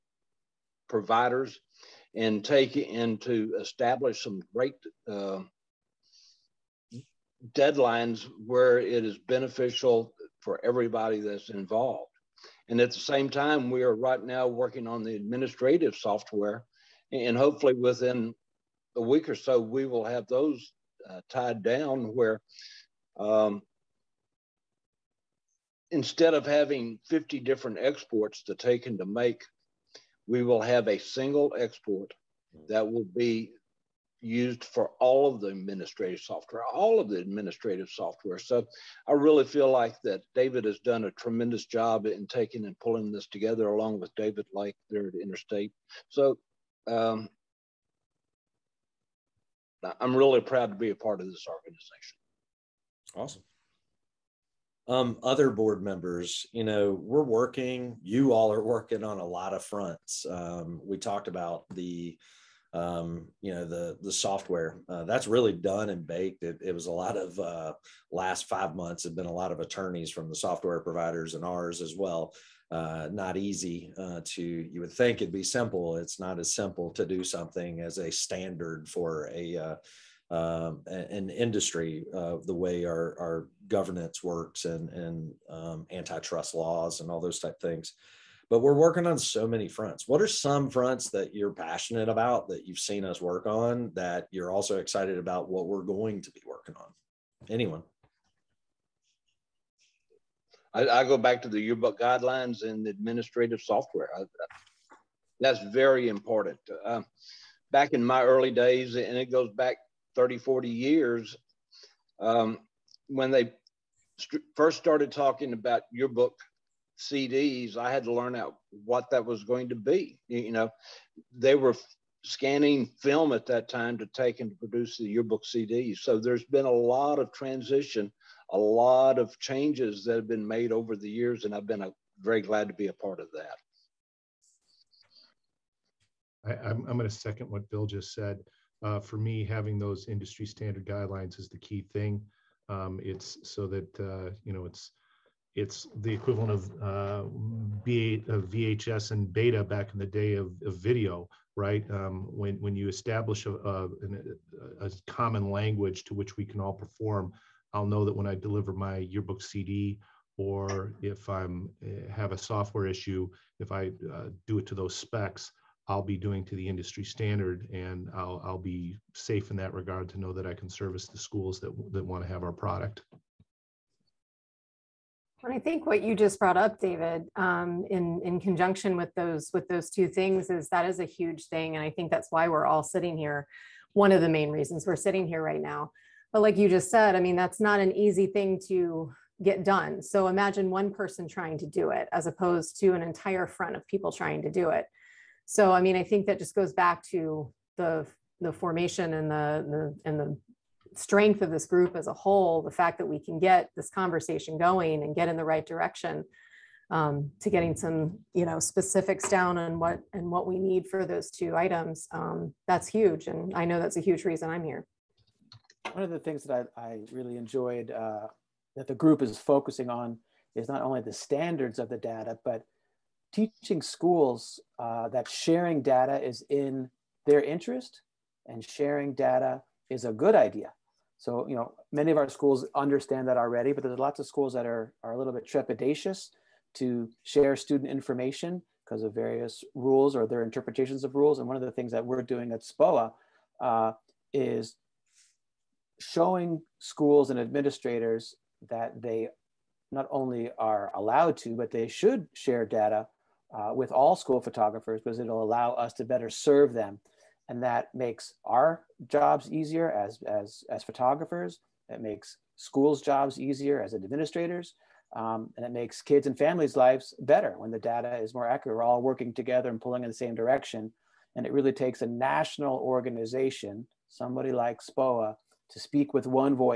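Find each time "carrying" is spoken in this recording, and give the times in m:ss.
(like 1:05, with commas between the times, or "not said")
not said.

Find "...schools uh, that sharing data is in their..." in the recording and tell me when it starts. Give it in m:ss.
3:43.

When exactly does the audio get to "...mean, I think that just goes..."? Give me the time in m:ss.
3:15.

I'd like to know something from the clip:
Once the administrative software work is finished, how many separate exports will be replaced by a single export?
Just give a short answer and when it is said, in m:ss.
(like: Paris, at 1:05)
50, at 0:27.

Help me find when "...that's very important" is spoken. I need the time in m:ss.
1:45.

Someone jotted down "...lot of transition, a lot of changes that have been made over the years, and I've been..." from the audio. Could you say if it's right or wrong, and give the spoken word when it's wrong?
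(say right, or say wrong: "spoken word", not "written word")
right.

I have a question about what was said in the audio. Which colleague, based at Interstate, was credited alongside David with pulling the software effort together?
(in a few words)
David Lake.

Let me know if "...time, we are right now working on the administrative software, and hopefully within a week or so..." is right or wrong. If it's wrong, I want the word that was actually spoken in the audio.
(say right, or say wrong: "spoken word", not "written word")
right.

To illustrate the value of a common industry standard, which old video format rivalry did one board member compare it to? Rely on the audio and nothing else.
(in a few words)
VHS and Beta.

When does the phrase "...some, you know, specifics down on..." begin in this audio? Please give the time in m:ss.
3:27.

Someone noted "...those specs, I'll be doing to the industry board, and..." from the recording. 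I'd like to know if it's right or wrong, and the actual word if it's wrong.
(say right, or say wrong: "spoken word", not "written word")
wrong: "standard", not "board".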